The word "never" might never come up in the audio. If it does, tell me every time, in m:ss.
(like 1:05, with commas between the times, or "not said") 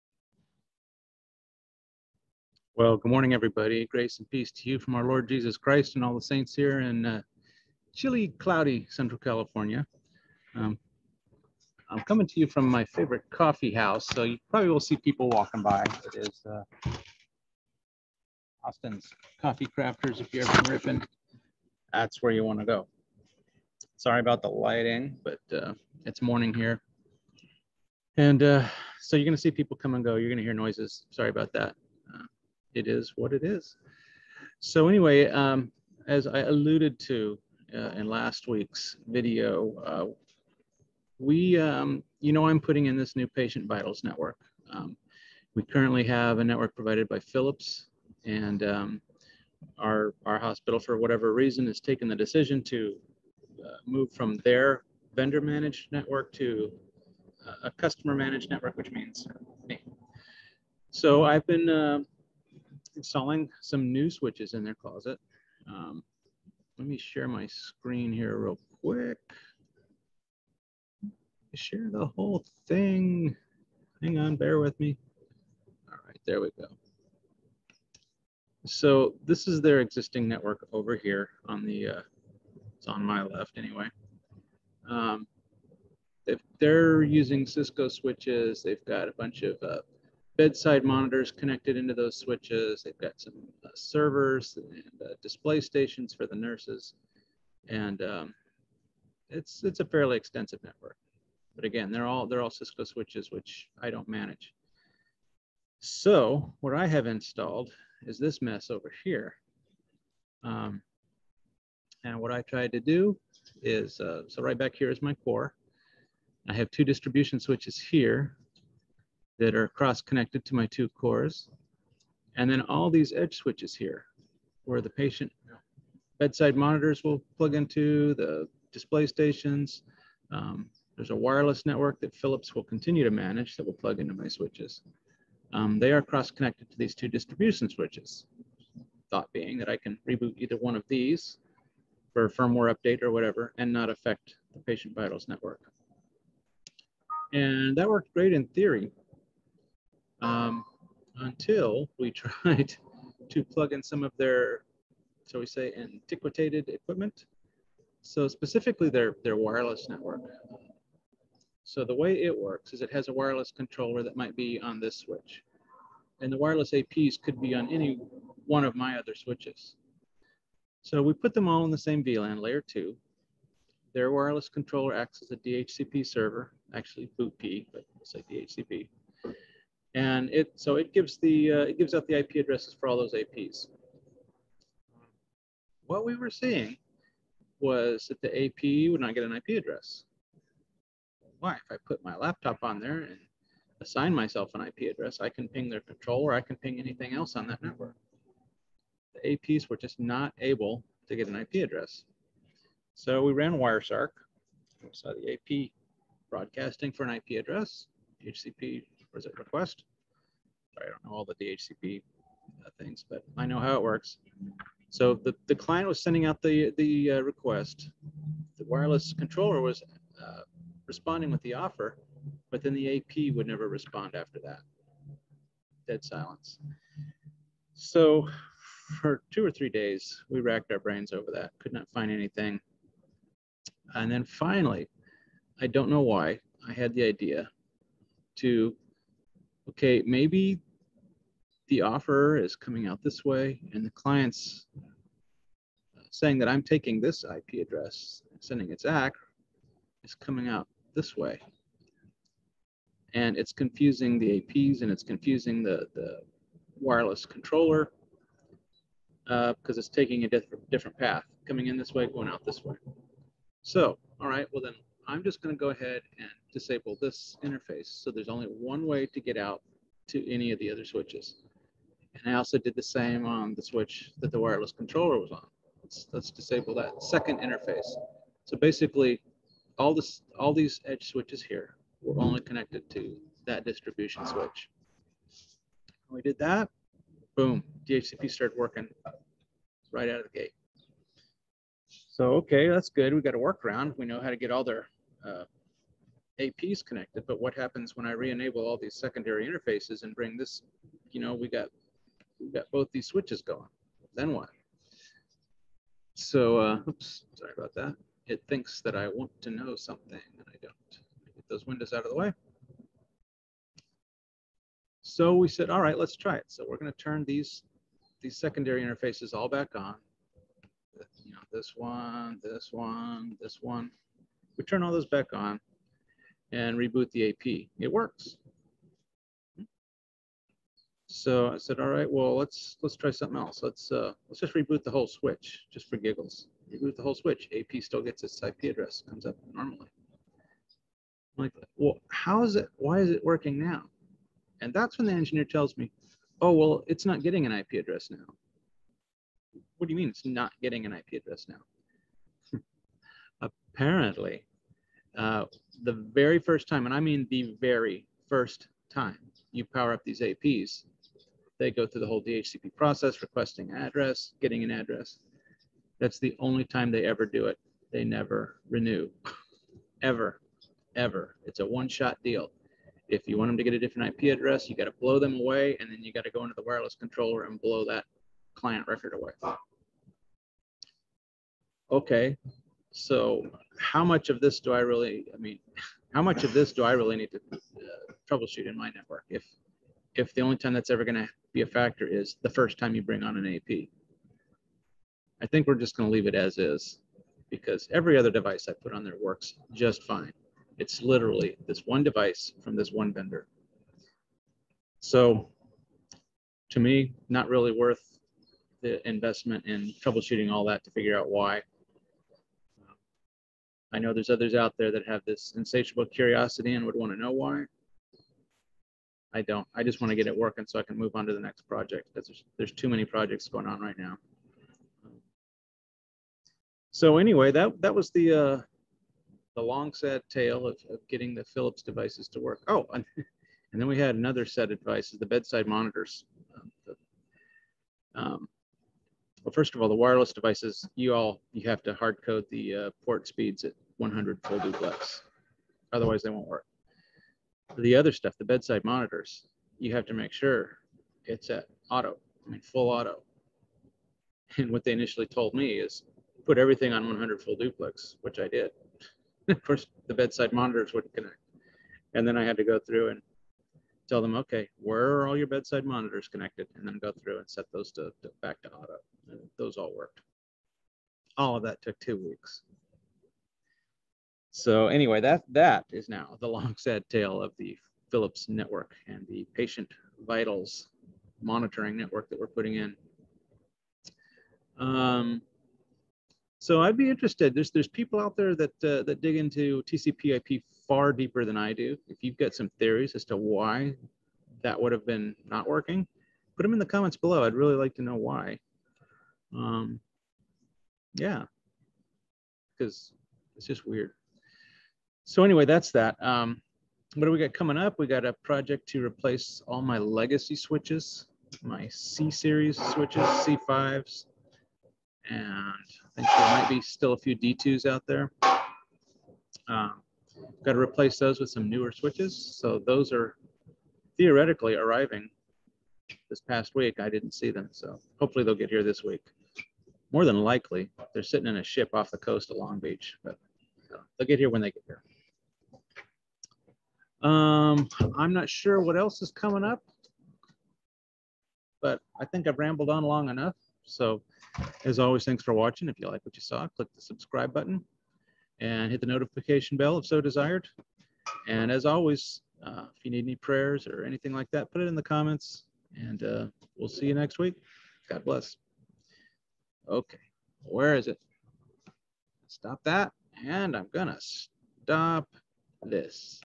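3:43, 6:08.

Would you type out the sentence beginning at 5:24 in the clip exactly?
We turn all those back on and reboot the AP.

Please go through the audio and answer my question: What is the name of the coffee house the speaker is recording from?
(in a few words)
Austin's Coffee Crafters.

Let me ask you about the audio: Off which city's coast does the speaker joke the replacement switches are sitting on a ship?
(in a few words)
Long Beach.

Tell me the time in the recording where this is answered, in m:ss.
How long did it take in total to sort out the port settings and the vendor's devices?
7:51.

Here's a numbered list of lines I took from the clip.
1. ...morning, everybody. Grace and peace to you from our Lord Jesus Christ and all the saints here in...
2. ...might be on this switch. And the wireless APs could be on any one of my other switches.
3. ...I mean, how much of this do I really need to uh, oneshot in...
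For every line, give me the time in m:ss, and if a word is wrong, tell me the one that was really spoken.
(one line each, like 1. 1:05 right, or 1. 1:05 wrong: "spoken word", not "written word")
1. 0:03 right
2. 2:44 right
3. 6:25 wrong: "troubleshoot", not "oneshot".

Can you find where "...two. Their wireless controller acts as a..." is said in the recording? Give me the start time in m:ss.
2:52.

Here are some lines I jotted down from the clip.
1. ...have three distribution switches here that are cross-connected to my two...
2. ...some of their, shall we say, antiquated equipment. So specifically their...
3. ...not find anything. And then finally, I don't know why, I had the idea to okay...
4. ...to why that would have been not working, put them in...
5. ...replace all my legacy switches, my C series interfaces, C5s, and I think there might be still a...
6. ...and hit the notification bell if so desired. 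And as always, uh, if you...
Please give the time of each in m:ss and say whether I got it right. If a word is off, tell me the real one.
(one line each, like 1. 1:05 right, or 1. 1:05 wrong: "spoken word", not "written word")
1. 1:56 wrong: "two", not "three"
2. 2:33 right
3. 3:51 right
4. 8:13 right
5. 8:29 wrong: "switches", not "interfaces"
6. 9:08 right.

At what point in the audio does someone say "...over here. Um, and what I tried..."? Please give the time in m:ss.
1:48.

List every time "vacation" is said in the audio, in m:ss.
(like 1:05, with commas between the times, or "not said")
not said.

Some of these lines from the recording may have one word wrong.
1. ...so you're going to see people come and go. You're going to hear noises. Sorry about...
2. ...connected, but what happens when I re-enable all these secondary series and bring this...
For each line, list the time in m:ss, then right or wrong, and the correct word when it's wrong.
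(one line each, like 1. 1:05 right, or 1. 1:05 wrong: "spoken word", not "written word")
1. 0:29 right
2. 4:56 wrong: "interfaces", not "series".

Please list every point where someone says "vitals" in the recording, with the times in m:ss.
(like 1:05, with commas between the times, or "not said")
0:43, 2:24, 8:00.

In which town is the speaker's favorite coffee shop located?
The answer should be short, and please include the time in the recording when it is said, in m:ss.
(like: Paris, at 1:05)
Ripon, at 0:20.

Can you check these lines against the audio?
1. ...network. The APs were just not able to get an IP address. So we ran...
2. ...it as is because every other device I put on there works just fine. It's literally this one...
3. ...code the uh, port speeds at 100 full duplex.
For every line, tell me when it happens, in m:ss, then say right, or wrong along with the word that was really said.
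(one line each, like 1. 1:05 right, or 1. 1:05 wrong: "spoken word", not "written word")
1. 3:17 right
2. 6:36 right
3. 7:22 right.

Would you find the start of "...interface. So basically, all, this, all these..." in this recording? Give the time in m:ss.
4:37.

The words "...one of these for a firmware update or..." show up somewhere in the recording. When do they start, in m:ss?
2:20.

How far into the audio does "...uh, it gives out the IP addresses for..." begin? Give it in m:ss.
3:01.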